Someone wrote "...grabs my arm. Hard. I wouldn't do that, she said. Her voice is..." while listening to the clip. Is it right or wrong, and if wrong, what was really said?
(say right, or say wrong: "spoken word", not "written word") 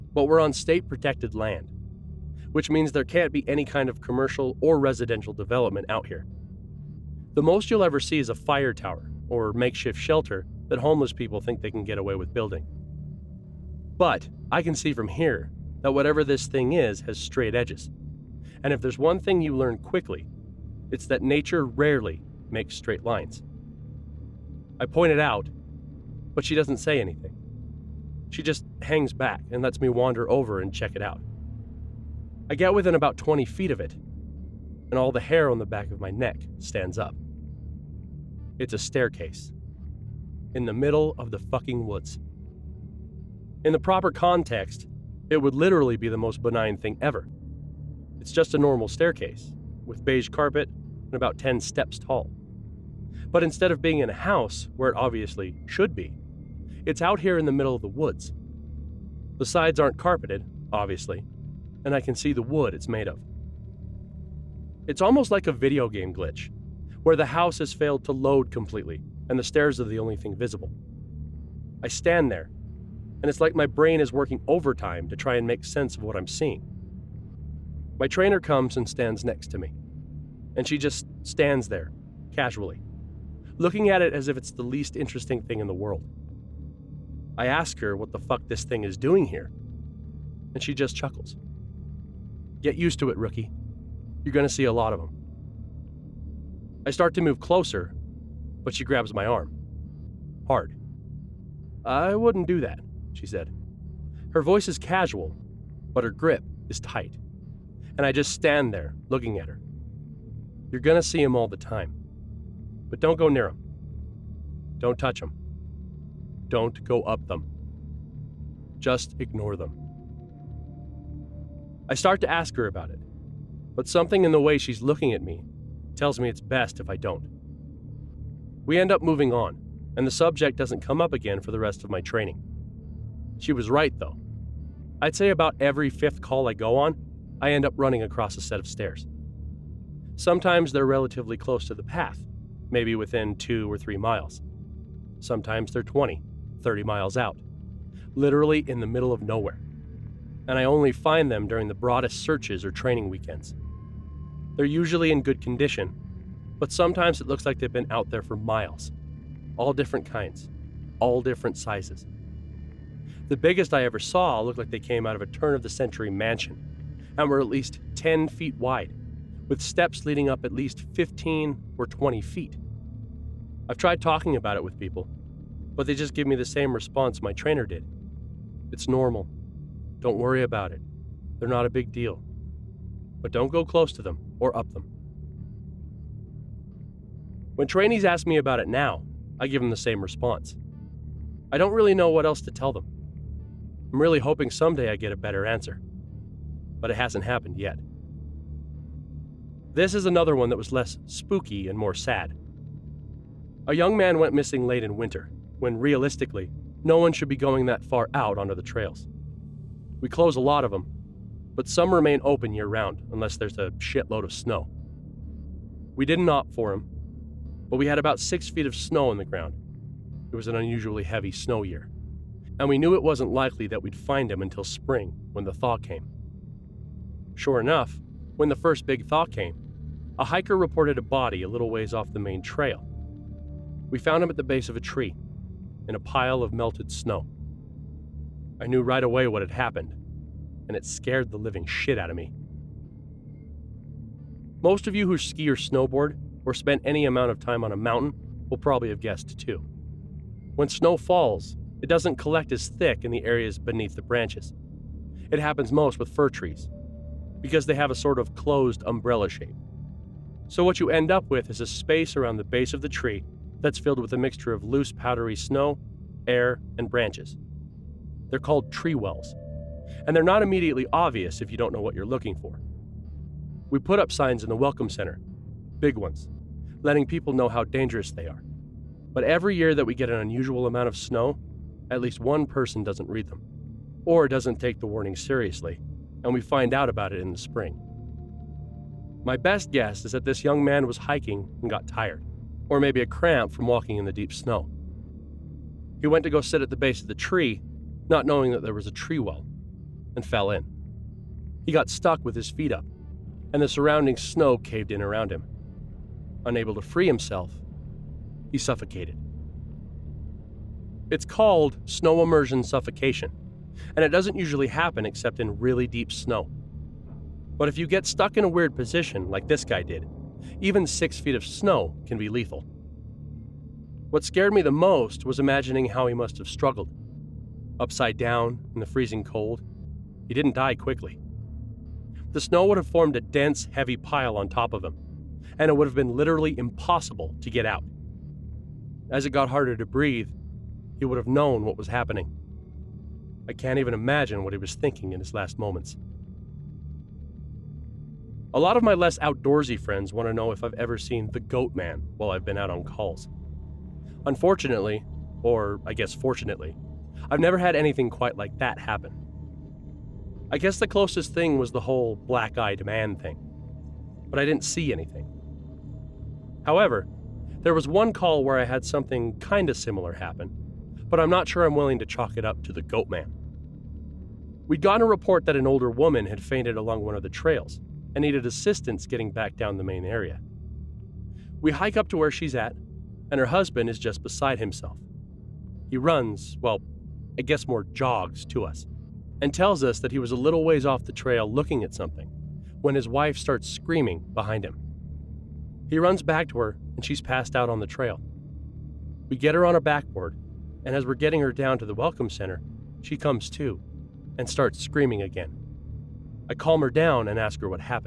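right.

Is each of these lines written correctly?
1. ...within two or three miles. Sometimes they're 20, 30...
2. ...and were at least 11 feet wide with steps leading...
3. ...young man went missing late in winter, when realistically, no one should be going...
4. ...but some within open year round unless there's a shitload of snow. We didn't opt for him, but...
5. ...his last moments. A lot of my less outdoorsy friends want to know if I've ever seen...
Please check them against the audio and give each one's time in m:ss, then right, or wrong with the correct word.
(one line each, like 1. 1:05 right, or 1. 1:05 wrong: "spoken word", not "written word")
1. 2:22 right
2. 2:47 wrong: "10", not "11"
3. 3:23 right
4. 3:31 wrong: "remain", not "within"
5. 5:45 right.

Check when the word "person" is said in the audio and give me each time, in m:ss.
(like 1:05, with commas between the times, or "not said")
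4:42.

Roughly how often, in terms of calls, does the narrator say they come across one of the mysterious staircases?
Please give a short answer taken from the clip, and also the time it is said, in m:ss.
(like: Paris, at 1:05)
Every fifth call, at 2:15.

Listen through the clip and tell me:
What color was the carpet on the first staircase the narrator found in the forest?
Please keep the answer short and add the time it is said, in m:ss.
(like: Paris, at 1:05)
Beige, at 0:50.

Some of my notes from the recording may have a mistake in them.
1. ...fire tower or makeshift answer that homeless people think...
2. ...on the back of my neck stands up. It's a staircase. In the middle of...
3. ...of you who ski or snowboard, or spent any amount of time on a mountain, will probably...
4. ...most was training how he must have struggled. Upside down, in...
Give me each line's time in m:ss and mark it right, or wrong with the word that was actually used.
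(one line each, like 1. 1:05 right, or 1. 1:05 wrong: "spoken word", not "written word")
1. 0:08 wrong: "shelter", not "answer"
2. 0:35 right
3. 4:04 right
4. 5:24 wrong: "imagining", not "training".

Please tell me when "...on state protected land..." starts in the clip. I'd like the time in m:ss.
0:00.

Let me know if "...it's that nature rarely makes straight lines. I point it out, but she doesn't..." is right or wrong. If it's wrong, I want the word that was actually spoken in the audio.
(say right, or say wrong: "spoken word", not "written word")
right.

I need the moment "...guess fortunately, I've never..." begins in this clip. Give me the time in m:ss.
5:55.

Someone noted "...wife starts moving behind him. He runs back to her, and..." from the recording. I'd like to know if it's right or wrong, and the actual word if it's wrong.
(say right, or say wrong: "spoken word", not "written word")
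wrong: "screaming", not "moving".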